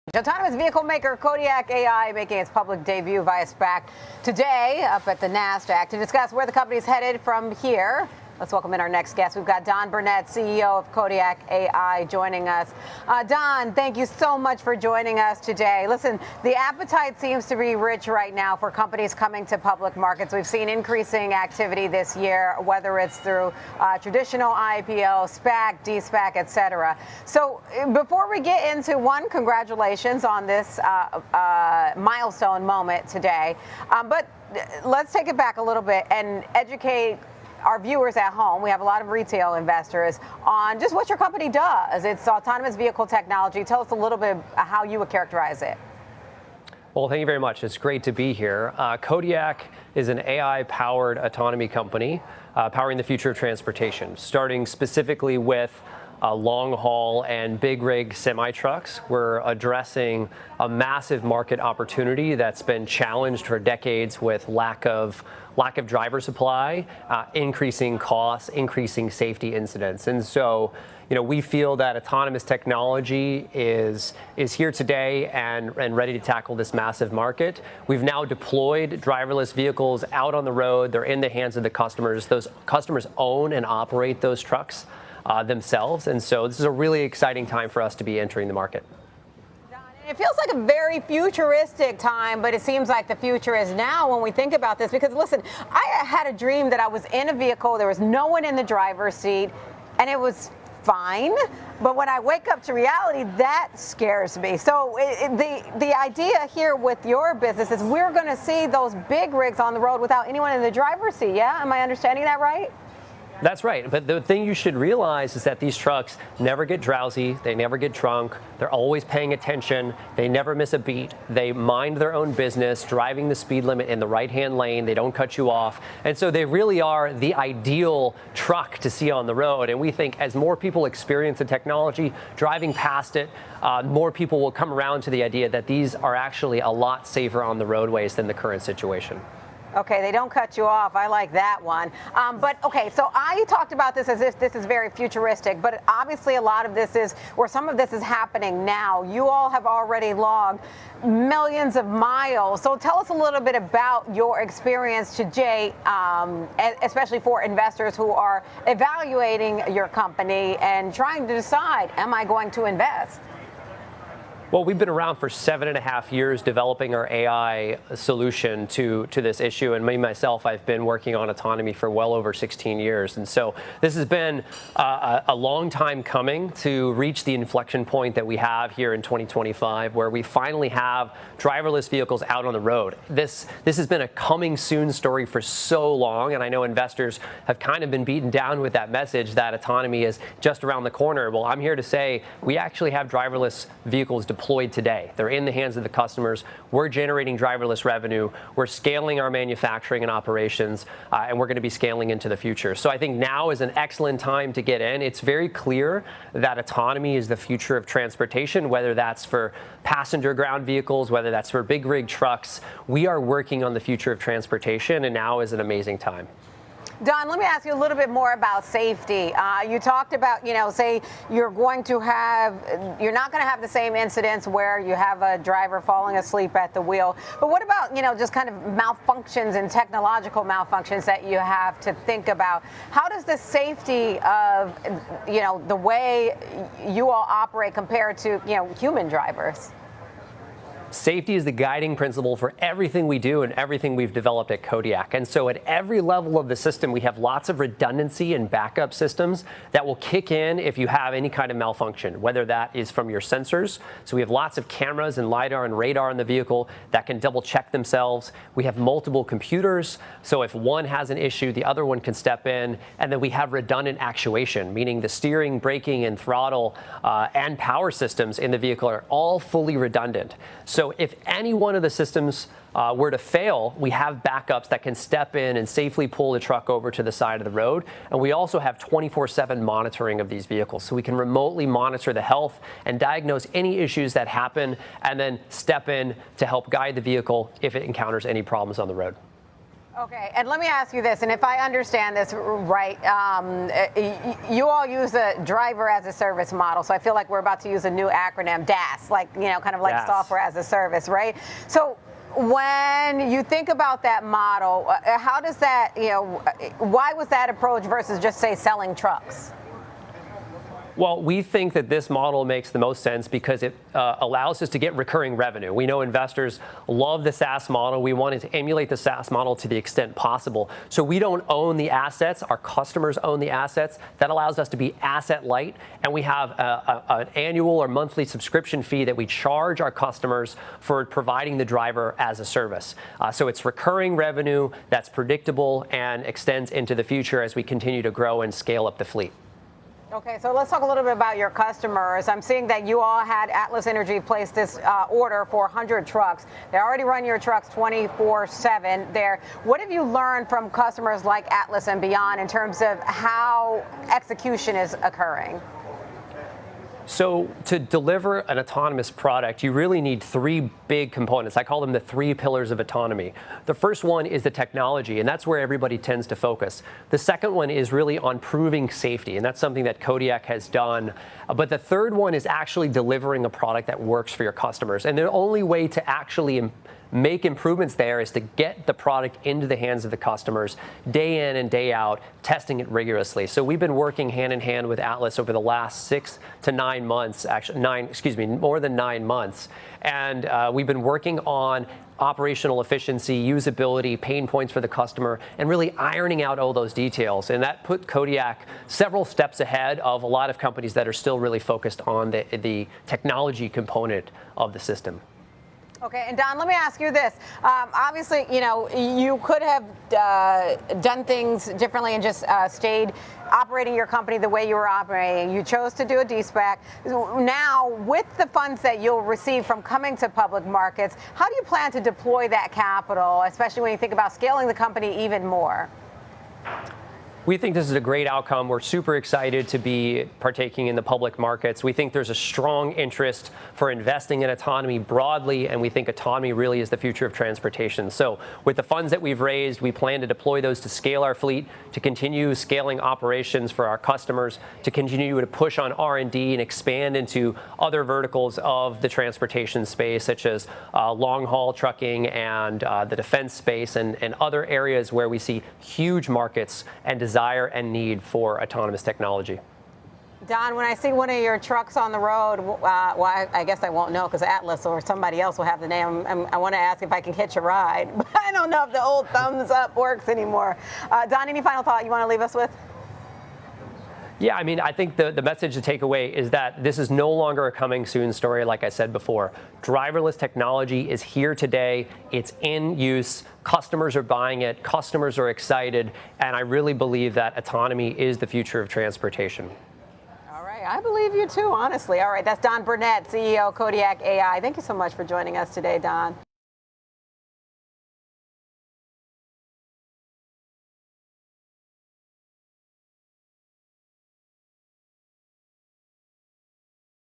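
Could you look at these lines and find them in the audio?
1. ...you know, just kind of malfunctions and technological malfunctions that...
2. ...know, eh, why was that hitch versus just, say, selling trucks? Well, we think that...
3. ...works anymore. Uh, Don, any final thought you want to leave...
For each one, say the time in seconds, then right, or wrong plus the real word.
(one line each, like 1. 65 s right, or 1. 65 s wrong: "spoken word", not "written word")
1. 227 s right
2. 306 s wrong: "approach", not "hitch"
3. 469 s right.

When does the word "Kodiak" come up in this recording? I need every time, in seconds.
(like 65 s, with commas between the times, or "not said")
1 s, 10 s, 48 s, 244 s, 369 s, 398 s, 493 s.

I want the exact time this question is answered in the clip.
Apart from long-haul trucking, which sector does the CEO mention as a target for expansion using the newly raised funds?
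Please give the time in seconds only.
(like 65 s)
453 s.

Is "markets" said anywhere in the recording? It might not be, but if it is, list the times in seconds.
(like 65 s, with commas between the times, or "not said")
19 s, 61 s, 77 s, 88 s, 420 s, 431 s, 456 s.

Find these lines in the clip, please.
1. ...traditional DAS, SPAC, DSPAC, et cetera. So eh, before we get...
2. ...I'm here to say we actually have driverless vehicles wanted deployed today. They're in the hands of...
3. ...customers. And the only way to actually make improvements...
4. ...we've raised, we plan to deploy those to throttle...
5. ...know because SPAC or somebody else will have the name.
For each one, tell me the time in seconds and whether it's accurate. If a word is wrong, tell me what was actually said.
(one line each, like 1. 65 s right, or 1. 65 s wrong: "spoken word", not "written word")
1. 23 s wrong: "IPO", not "DAS"
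2. 191 s wrong: "deployed", not "wanted"
3. 374 s right
4. 439 s wrong: "scale", not "throttle"
5. 464 s wrong: "Atlas", not "SPAC".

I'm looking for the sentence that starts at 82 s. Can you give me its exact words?
Those customers own and operate those trucks uh, themselves.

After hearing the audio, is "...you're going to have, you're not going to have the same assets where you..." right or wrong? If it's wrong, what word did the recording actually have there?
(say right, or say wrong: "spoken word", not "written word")
wrong: "incidents", not "assets".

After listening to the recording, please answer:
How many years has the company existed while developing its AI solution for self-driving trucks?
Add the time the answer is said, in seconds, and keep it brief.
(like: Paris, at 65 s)
seven and a half years, at 165 s.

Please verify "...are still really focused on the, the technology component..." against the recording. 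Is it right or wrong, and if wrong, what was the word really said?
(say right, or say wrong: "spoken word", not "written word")
right.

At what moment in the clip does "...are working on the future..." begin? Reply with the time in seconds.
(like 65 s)
213 s.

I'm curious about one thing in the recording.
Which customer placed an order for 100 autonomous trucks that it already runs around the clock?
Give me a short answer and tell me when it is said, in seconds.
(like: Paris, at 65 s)
Atlas Energy, at 343 s.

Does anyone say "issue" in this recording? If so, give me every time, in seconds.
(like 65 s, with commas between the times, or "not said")
169 s, 261 s, 283 s.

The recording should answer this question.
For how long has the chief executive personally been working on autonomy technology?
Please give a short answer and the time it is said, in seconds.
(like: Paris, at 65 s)
over 16 years, at 171 s.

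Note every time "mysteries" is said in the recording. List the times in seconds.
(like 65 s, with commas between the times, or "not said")
not said.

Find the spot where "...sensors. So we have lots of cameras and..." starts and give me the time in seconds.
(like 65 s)
253 s.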